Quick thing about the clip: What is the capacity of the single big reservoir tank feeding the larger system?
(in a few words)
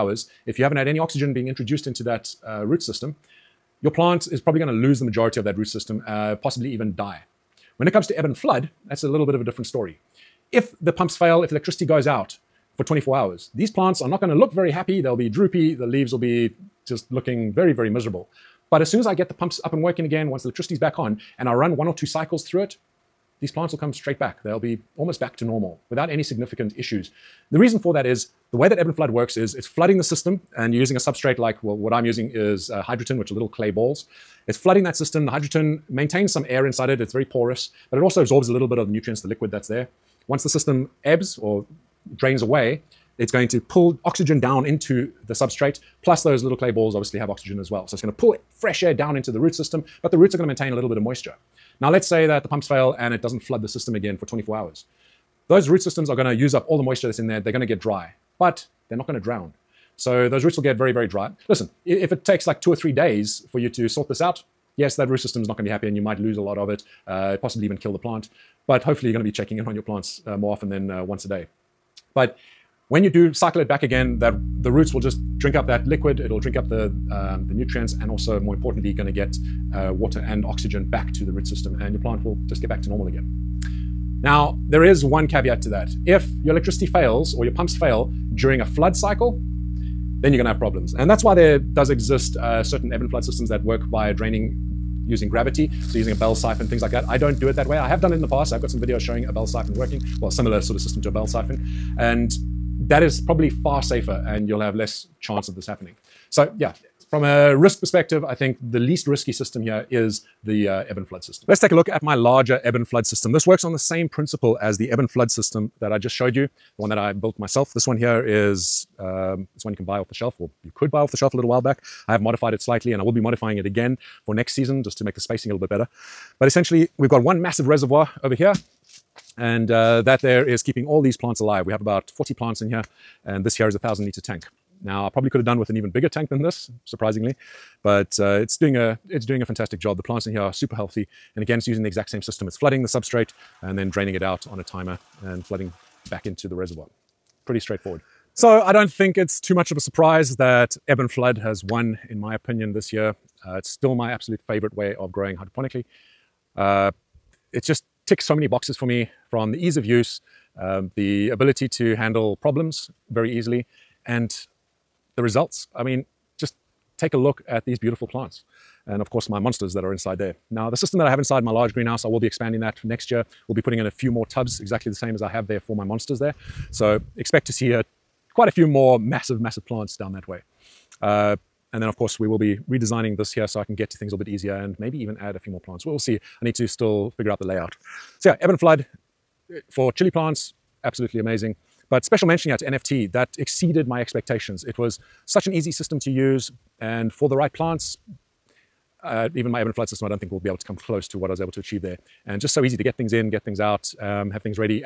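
1,000 liters.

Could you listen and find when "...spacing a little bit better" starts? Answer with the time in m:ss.
2:05.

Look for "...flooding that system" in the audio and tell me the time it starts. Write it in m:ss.
0:34.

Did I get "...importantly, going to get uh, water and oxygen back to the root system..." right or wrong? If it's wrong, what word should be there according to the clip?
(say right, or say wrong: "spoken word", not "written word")
right.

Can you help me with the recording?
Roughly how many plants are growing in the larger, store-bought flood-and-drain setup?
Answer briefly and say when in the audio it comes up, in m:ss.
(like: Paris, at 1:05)
40, at 2:12.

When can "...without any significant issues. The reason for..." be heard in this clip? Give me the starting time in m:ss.
0:25.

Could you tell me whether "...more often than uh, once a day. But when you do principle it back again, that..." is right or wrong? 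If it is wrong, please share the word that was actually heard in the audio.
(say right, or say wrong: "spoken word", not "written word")
wrong: "cycle", not "principle".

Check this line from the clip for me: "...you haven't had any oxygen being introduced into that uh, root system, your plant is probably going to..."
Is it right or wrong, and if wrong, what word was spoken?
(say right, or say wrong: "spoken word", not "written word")
right.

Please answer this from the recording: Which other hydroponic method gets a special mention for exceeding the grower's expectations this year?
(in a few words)
NFT.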